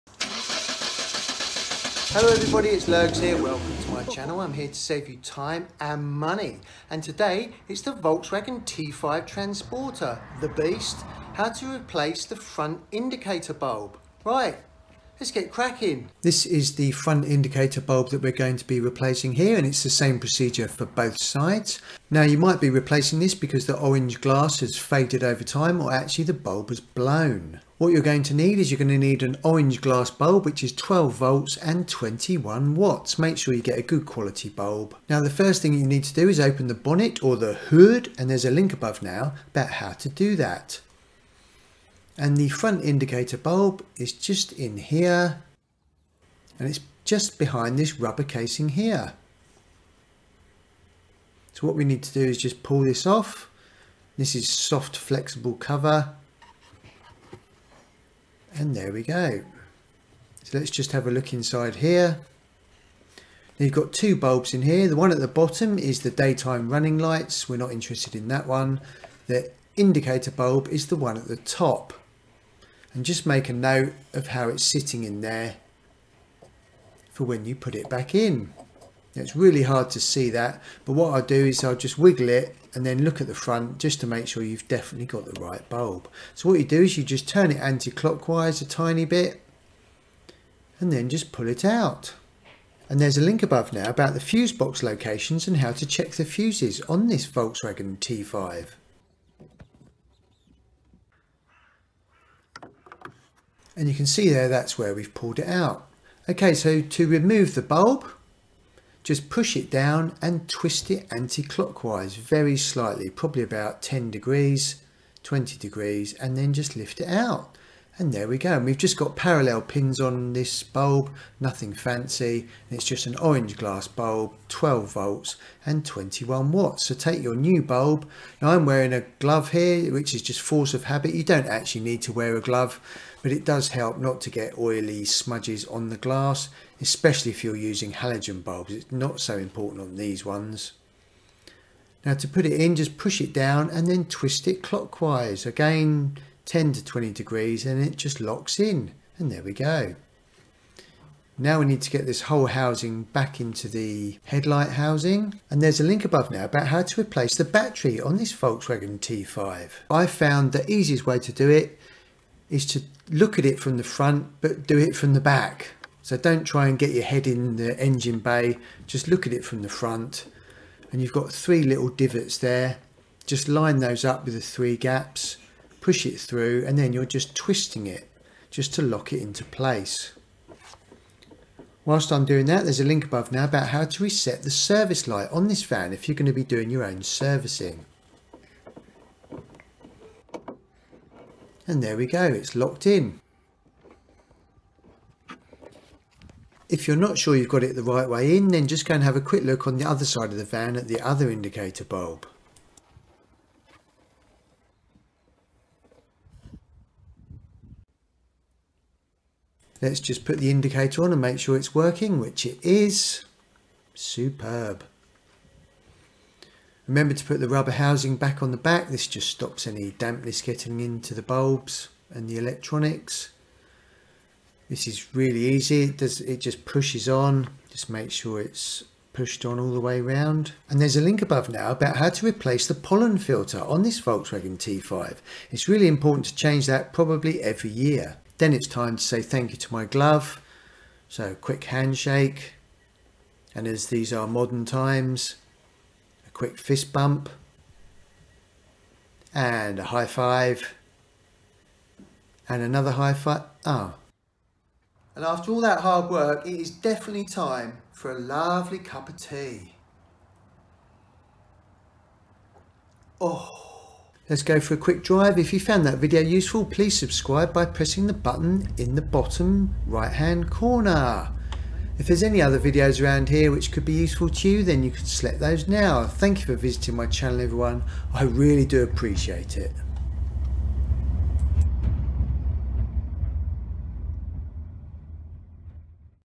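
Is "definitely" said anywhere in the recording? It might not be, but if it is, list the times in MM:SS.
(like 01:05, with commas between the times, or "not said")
01:24, 04:16.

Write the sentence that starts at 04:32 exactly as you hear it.
If there's any other videos around here which could be useful to you, then you can select those now.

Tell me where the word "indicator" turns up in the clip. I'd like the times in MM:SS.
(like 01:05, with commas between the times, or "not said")
00:12, 00:17, 00:42, 01:09, 03:21, 03:30.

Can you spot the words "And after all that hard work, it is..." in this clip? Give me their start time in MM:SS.
04:15.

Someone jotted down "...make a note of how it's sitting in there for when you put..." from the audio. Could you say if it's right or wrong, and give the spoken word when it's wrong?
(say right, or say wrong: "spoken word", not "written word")
right.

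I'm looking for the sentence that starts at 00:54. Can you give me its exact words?
This is soft flexible cover and there we go.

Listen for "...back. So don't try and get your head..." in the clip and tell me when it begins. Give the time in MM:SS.
02:45.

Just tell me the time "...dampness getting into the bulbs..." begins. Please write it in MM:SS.
03:39.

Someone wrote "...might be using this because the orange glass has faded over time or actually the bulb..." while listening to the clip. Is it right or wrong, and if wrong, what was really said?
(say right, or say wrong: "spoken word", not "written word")
wrong: "replacing", not "using".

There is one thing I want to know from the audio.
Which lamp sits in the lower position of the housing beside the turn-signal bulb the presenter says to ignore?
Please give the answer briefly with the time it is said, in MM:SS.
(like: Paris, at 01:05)
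daytime running lights, at 01:06.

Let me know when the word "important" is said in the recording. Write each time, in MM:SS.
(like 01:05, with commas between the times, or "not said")
02:19, 03:55.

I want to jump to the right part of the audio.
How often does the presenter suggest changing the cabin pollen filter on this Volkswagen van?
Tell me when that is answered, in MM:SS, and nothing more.
03:57.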